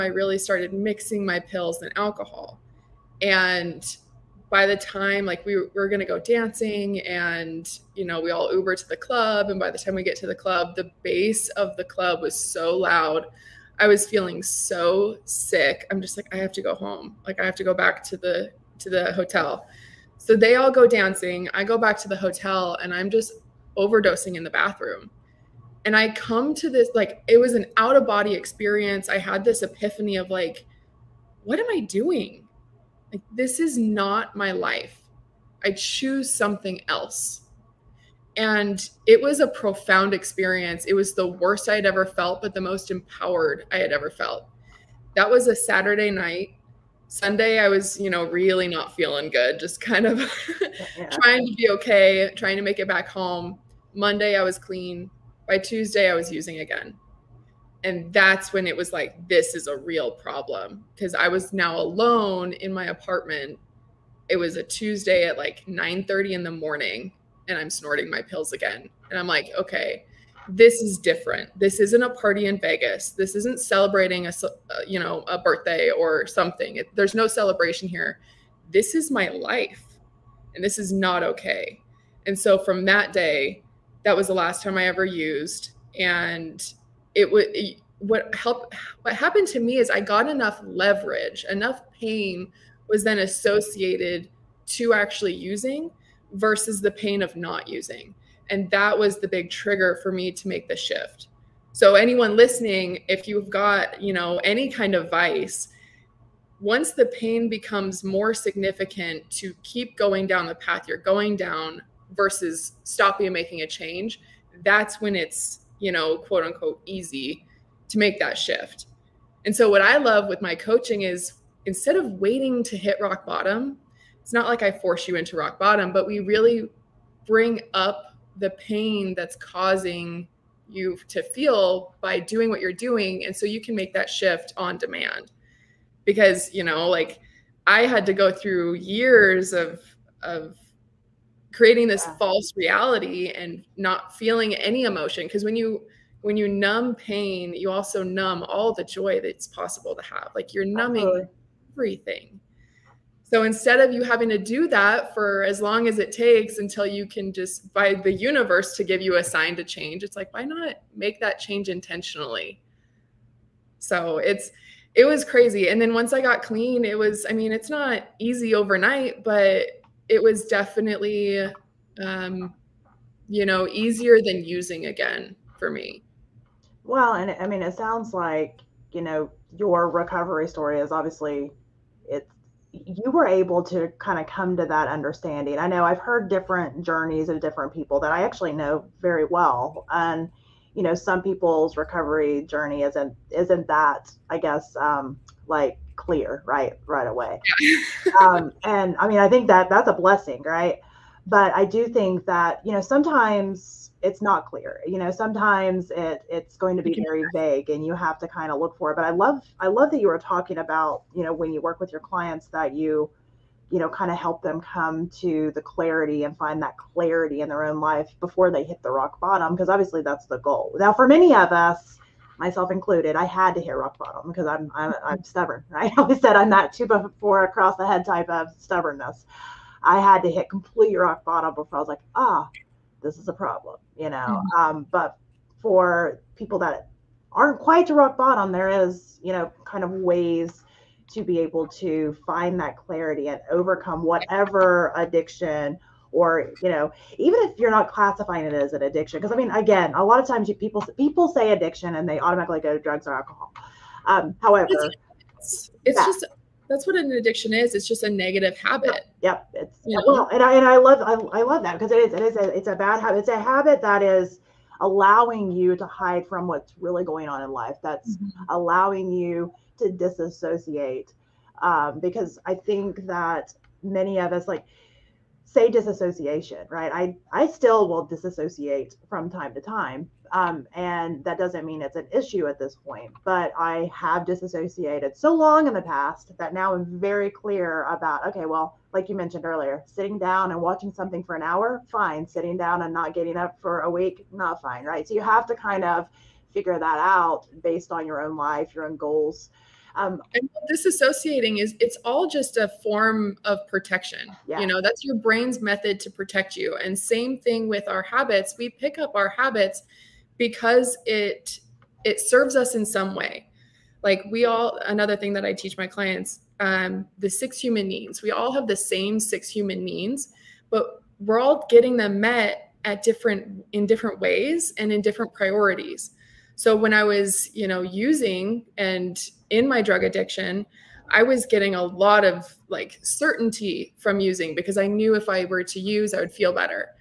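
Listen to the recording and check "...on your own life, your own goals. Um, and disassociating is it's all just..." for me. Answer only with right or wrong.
right.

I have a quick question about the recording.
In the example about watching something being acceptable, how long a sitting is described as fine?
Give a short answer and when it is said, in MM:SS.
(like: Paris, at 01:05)
an hour, at 04:51.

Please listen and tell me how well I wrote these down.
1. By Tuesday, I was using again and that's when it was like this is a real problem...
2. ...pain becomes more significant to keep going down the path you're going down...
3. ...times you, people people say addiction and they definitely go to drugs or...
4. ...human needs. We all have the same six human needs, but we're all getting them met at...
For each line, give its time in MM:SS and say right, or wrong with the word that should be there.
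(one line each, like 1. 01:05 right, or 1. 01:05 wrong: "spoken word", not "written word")
1. 00:55 right
2. 01:47 right
3. 04:10 wrong: "automatically", not "definitely"
4. 05:17 right.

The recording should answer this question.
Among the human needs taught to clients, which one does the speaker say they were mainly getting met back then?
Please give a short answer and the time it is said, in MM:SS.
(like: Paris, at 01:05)
certainty, at 05:33.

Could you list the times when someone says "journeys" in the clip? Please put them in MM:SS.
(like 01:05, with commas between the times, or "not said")
03:06, 03:12.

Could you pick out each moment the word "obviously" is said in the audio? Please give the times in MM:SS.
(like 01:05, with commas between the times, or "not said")
03:00, 03:39.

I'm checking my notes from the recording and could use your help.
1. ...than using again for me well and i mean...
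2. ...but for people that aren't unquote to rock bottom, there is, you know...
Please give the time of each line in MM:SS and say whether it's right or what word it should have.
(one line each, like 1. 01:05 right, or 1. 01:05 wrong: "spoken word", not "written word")
1. 02:54 right
2. 03:54 wrong: "quite", not "unquote".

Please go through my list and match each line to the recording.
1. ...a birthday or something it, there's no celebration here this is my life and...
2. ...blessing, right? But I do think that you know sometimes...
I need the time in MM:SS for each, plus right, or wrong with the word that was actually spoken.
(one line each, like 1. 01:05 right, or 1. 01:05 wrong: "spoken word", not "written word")
1. 01:15 right
2. 03:19 right.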